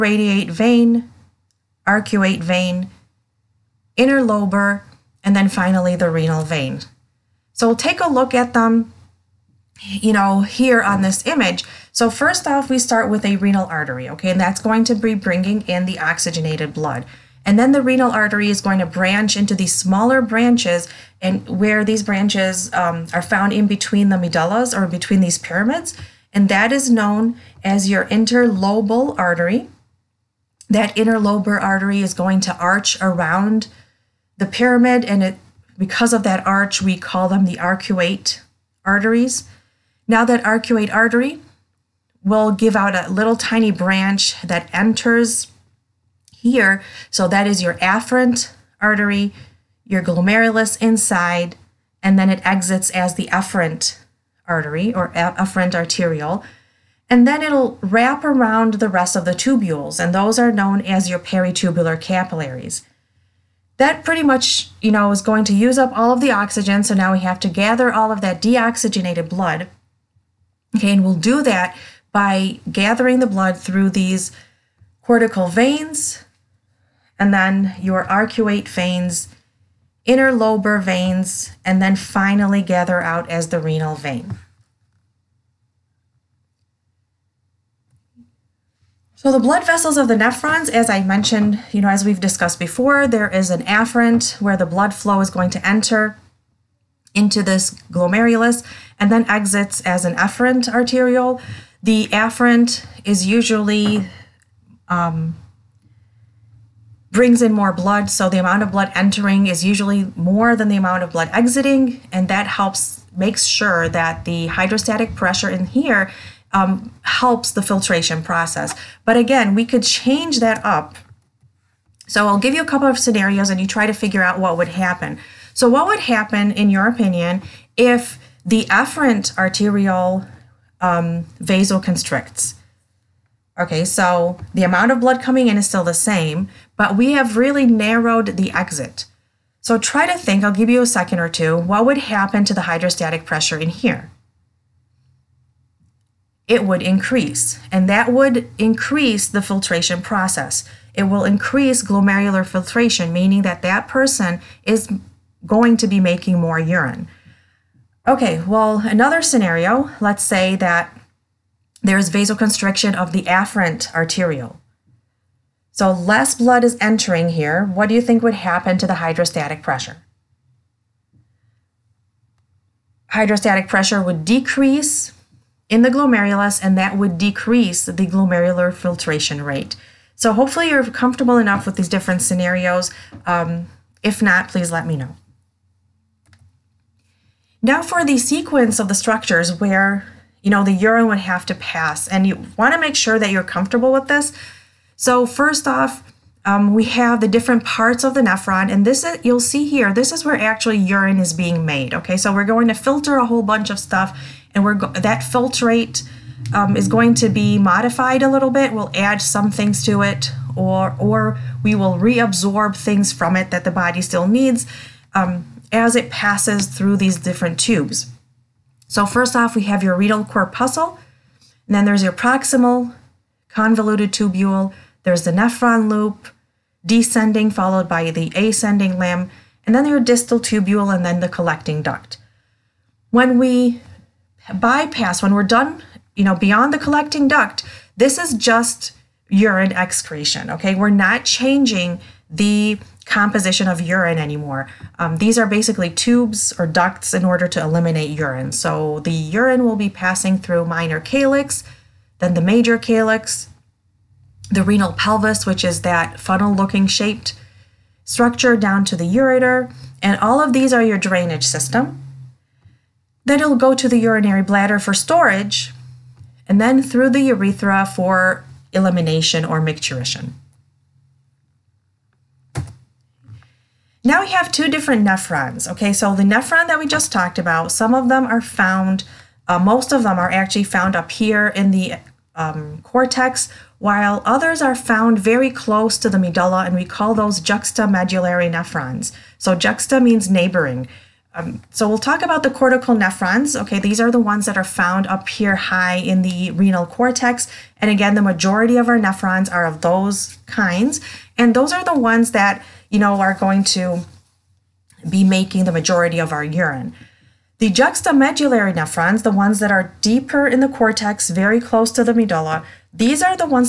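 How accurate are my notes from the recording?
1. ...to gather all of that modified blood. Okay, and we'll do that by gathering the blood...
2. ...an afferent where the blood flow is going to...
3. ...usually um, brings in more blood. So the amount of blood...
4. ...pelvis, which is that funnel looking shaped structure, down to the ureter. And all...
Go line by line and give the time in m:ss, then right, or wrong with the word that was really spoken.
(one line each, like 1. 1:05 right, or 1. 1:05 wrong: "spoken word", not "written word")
1. 1:07 wrong: "deoxygenated", not "modified"
2. 1:33 right
3. 1:43 right
4. 4:14 right.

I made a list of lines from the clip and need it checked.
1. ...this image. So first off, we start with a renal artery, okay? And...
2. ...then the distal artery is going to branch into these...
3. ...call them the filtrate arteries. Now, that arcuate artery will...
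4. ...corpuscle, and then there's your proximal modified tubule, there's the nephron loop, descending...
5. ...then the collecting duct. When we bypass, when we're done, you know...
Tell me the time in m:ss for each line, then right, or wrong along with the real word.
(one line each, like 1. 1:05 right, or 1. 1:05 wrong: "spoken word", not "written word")
1. 0:11 right
2. 0:17 wrong: "renal", not "distal"
3. 0:36 wrong: "arcuate", not "filtrate"
4. 3:40 wrong: "convoluted", not "modified"
5. 3:51 right.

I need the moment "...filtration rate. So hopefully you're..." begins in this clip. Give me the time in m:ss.
2:58.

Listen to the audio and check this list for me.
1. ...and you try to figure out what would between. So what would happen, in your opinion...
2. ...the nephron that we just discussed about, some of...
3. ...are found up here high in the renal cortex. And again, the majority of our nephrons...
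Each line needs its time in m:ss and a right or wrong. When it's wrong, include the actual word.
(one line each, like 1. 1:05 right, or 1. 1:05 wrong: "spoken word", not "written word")
1. 2:03 wrong: "happen", not "between"
2. 4:36 wrong: "talked", not "discussed"
3. 4:54 right.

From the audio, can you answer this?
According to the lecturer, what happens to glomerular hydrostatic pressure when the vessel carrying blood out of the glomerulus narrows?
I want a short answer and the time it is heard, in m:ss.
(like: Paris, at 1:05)
It would increase, at 2:26.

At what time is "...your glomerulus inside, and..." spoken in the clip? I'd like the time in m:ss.
0:49.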